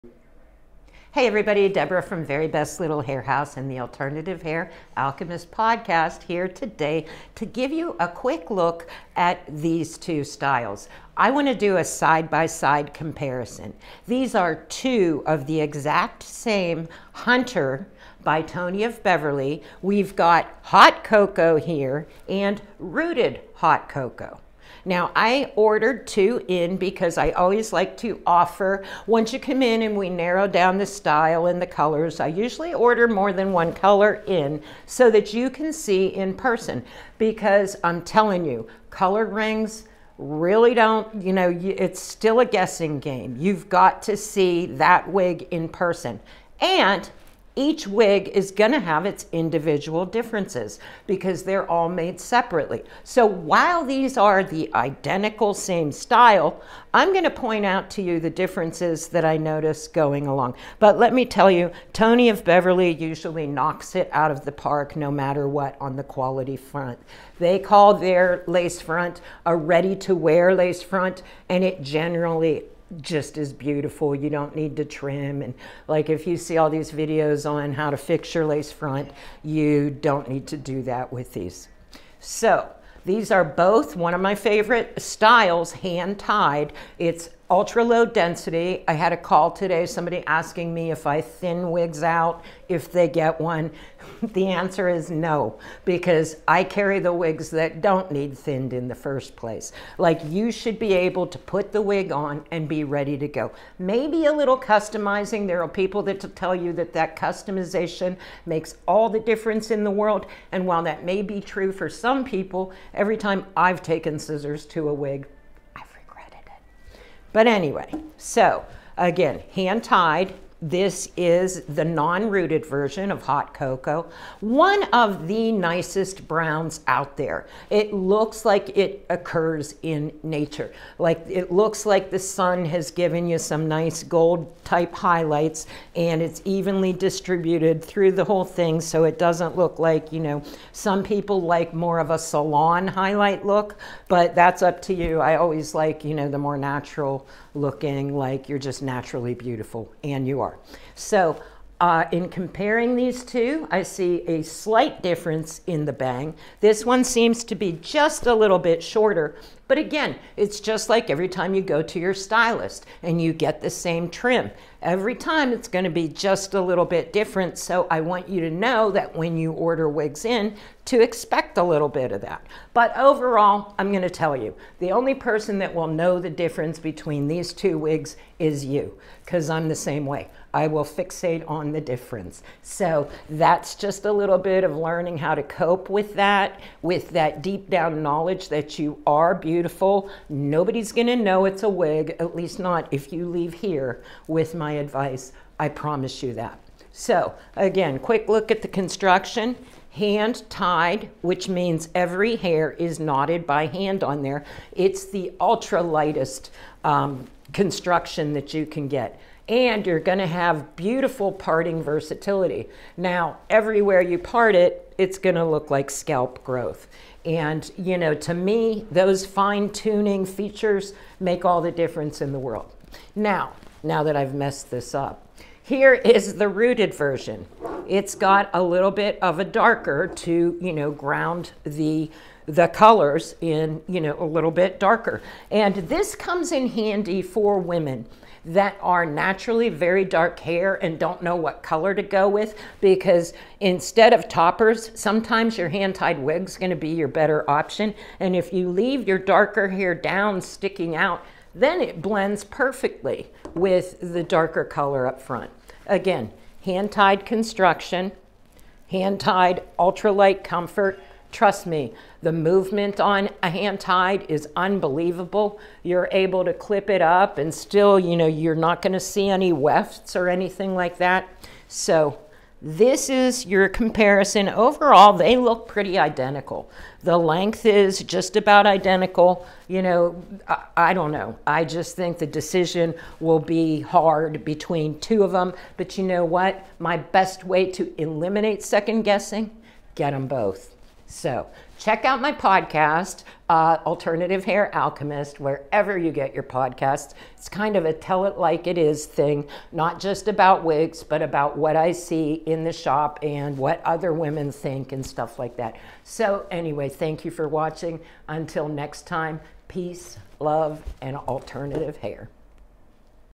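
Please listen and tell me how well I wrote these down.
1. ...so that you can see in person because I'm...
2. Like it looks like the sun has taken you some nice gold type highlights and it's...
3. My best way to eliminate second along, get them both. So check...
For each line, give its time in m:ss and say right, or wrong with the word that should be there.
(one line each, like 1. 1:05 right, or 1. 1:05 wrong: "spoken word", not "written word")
1. 0:34 right
2. 2:10 wrong: "given", not "taken"
3. 4:46 wrong: "guessing", not "along".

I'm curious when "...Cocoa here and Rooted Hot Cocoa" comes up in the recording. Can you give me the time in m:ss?
0:21.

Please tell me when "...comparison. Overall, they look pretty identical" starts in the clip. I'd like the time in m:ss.
4:33.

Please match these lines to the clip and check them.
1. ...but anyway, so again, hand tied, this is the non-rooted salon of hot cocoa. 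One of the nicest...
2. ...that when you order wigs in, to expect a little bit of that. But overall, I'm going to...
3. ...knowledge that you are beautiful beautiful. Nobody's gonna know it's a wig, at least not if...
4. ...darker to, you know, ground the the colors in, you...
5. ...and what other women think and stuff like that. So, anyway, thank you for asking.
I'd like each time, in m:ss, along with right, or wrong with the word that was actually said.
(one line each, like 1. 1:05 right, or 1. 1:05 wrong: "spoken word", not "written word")
1. 1:57 wrong: "version", not "salon"
2. 2:48 right
3. 3:08 right
4. 3:49 right
5. 5:03 wrong: "watching", not "asking".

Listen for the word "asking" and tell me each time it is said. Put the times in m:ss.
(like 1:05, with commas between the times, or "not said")
1:30.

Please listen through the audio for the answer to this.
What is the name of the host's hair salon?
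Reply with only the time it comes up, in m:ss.
0:02.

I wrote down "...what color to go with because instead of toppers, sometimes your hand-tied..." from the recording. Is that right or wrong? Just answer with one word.
right.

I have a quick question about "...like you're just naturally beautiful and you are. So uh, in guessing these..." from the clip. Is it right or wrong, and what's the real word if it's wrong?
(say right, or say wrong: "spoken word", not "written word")
wrong: "comparing", not "guessing".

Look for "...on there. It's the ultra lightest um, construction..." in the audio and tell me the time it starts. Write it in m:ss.
3:24.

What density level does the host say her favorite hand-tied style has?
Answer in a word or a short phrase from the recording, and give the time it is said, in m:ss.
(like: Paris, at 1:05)
ultra low density, at 1:27.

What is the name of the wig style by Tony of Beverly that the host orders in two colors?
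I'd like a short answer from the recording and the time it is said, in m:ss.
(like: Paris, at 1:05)
Hunter, at 0:17.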